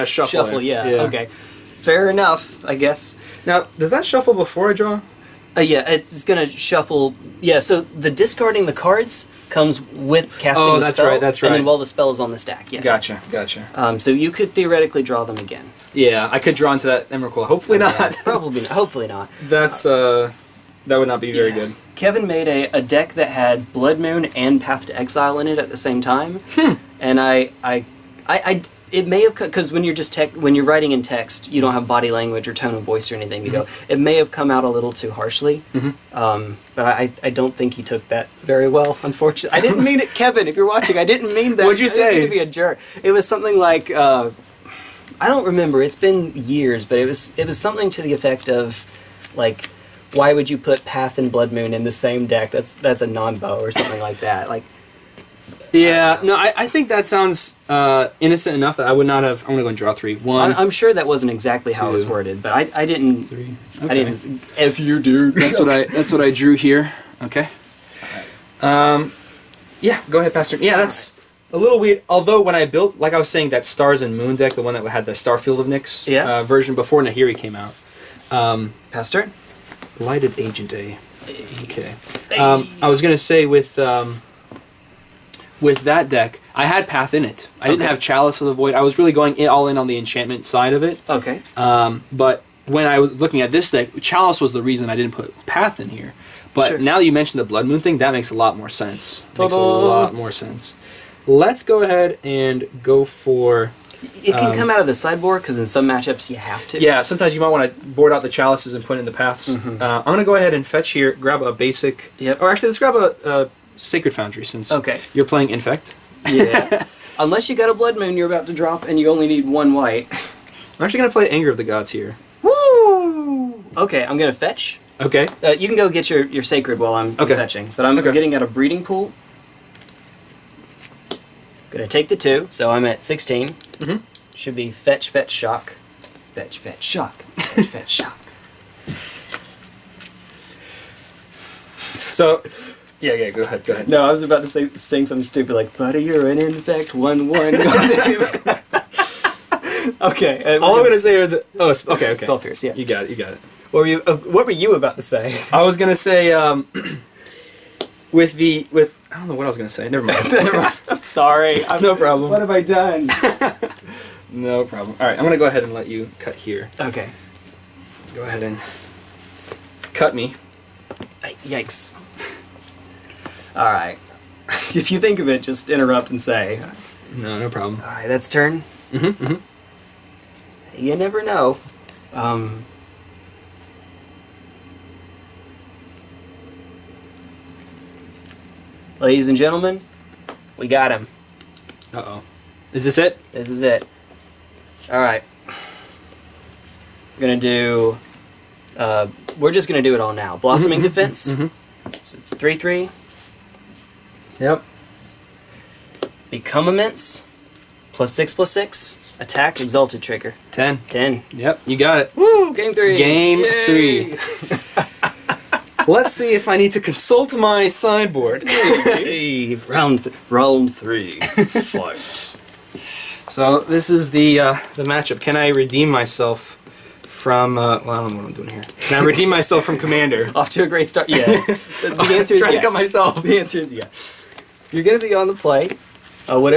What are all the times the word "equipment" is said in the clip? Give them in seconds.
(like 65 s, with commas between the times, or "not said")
not said.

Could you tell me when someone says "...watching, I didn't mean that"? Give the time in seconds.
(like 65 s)
40 s.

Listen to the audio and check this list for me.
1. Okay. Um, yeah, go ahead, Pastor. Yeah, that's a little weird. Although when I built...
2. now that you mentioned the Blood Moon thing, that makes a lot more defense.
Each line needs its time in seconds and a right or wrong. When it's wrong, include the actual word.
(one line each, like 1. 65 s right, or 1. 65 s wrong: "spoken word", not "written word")
1. 67 s right
2. 96 s wrong: "sense", not "defense".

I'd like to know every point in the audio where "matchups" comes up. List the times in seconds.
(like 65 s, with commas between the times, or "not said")
105 s, 224 s.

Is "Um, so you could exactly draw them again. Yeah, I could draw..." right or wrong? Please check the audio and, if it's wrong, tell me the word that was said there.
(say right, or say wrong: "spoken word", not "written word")
wrong: "theoretically", not "exactly".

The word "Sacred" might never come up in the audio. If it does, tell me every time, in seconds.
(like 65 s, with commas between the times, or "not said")
113 s, 126 s.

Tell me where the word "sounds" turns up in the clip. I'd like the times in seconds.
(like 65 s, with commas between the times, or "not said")
57 s.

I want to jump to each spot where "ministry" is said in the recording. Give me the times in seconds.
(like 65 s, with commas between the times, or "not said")
not said.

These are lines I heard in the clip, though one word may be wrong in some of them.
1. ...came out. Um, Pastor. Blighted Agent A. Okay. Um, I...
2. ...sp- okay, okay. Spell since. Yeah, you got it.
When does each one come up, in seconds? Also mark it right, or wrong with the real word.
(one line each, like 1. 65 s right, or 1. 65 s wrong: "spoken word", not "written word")
1. 77 s right
2. 151 s wrong: "pierce", not "since".